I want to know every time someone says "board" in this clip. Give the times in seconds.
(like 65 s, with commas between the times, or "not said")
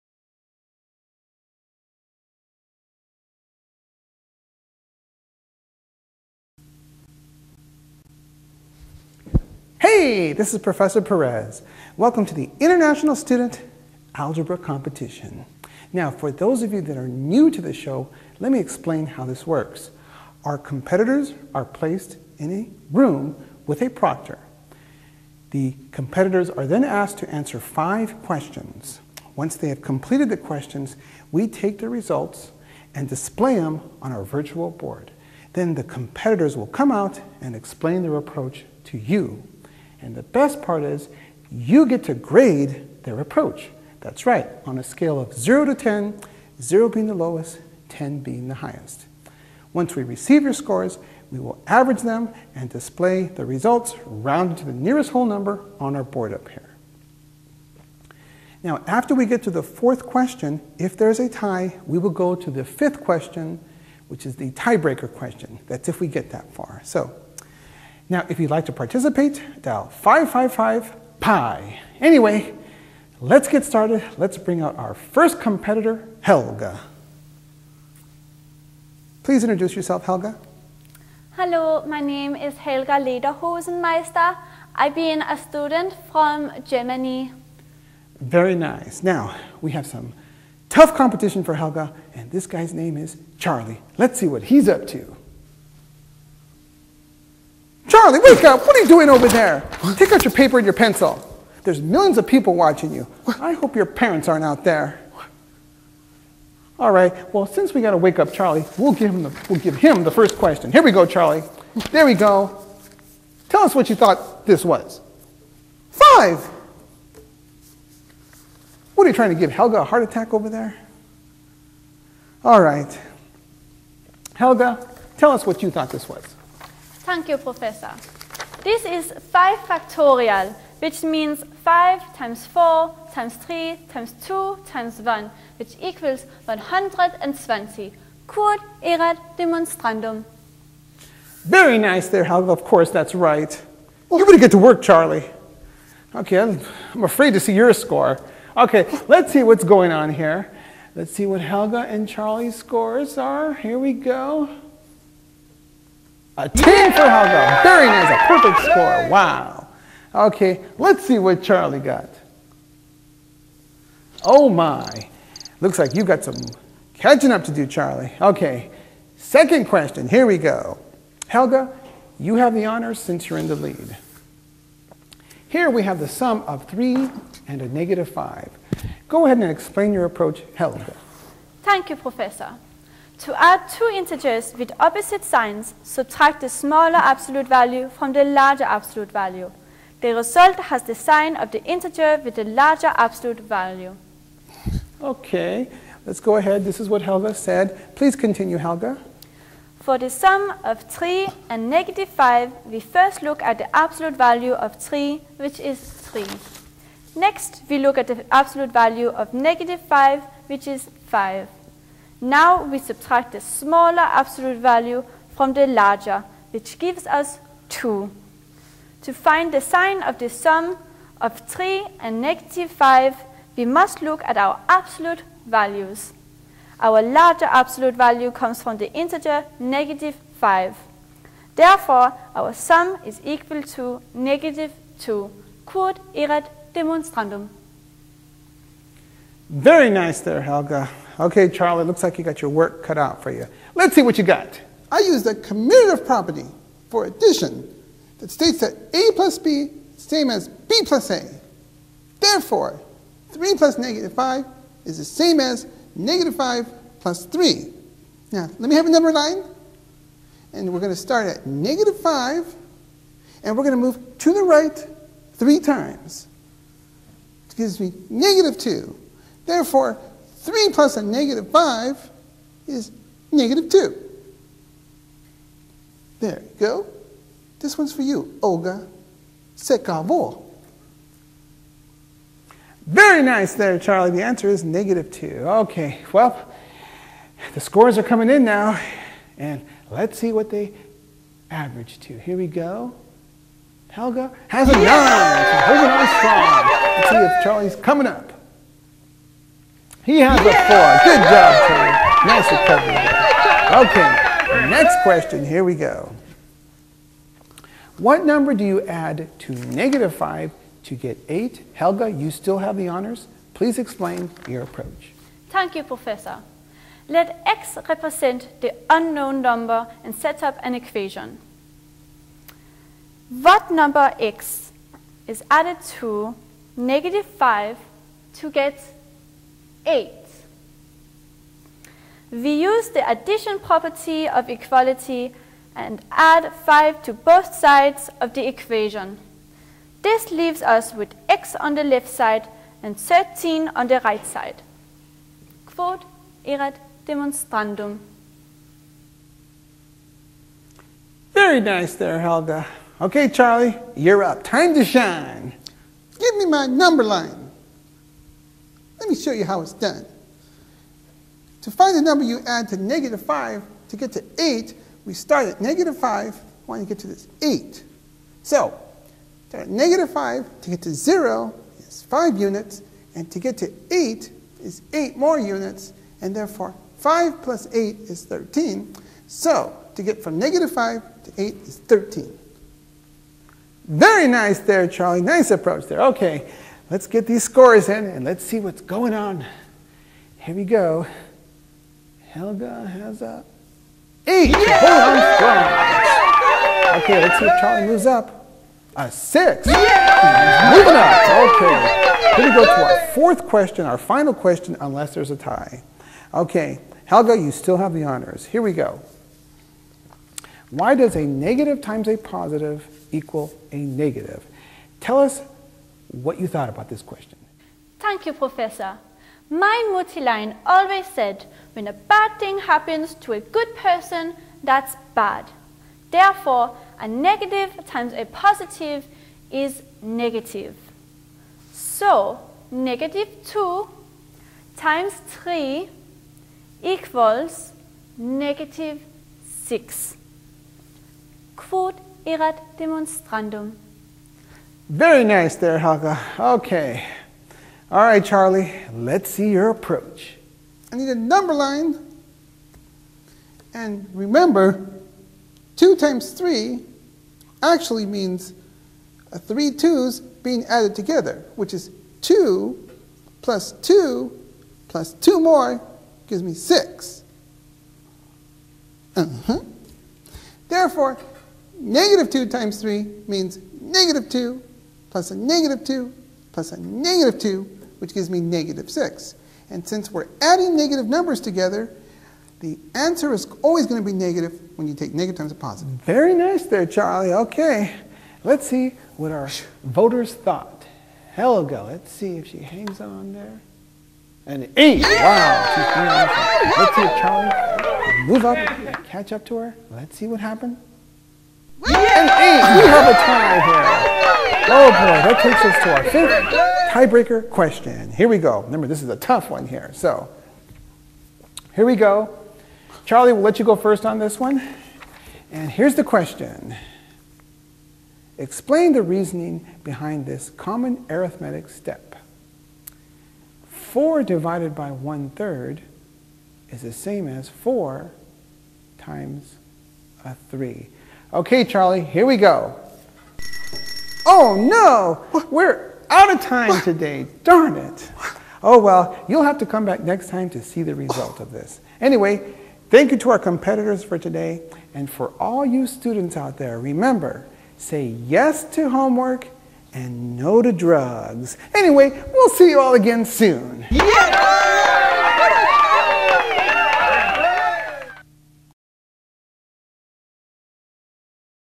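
34 s, 56 s.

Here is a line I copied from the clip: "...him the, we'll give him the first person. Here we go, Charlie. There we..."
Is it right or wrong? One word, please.
wrong.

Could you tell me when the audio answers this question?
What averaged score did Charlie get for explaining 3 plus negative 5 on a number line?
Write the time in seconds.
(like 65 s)
300 s.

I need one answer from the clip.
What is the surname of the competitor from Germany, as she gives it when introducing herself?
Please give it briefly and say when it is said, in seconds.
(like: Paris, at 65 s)
Lederhosenmeister, at 82 s.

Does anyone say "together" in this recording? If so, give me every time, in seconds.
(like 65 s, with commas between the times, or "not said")
460 s, 481 s.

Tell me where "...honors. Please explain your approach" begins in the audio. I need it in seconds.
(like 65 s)
312 s.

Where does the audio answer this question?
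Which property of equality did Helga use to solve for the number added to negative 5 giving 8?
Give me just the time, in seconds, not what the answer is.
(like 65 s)
333 s.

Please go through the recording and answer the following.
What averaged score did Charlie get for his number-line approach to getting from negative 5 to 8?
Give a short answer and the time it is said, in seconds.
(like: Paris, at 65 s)
6, at 399 s.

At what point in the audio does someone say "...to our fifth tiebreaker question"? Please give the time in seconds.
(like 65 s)
505 s.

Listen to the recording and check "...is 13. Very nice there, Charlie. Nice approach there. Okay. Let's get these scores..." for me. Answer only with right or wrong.
right.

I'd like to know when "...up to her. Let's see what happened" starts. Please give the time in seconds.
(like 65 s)
499 s.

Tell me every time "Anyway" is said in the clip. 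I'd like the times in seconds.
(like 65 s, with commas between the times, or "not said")
72 s, 541 s, 551 s.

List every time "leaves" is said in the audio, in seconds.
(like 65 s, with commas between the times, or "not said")
340 s.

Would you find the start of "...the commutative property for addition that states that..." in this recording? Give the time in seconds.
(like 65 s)
245 s.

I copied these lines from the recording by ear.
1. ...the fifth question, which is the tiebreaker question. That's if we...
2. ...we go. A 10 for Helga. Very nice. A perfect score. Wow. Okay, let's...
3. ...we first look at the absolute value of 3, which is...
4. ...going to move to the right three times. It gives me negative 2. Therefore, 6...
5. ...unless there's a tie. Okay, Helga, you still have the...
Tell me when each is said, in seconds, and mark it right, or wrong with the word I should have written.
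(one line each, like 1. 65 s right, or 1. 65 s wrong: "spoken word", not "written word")
1. 62 s right
2. 153 s right
3. 202 s right
4. 263 s wrong: "3", not "6"
5. 404 s right.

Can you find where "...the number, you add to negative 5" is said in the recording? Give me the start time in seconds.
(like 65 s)
361 s.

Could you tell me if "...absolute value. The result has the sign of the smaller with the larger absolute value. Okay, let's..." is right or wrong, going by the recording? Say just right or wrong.
wrong.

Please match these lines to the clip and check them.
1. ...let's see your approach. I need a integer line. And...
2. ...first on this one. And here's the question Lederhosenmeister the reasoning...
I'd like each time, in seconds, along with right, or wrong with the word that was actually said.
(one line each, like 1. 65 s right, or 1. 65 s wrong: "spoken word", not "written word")
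1. 448 s wrong: "number", not "integer"
2. 513 s wrong: "Explain", not "Lederhosenmeister".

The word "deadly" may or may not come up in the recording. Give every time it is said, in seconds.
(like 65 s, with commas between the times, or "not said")
not said.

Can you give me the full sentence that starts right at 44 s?
That's right, on a scale of 0 to 10, 0 being the lowest, 10 being the highest.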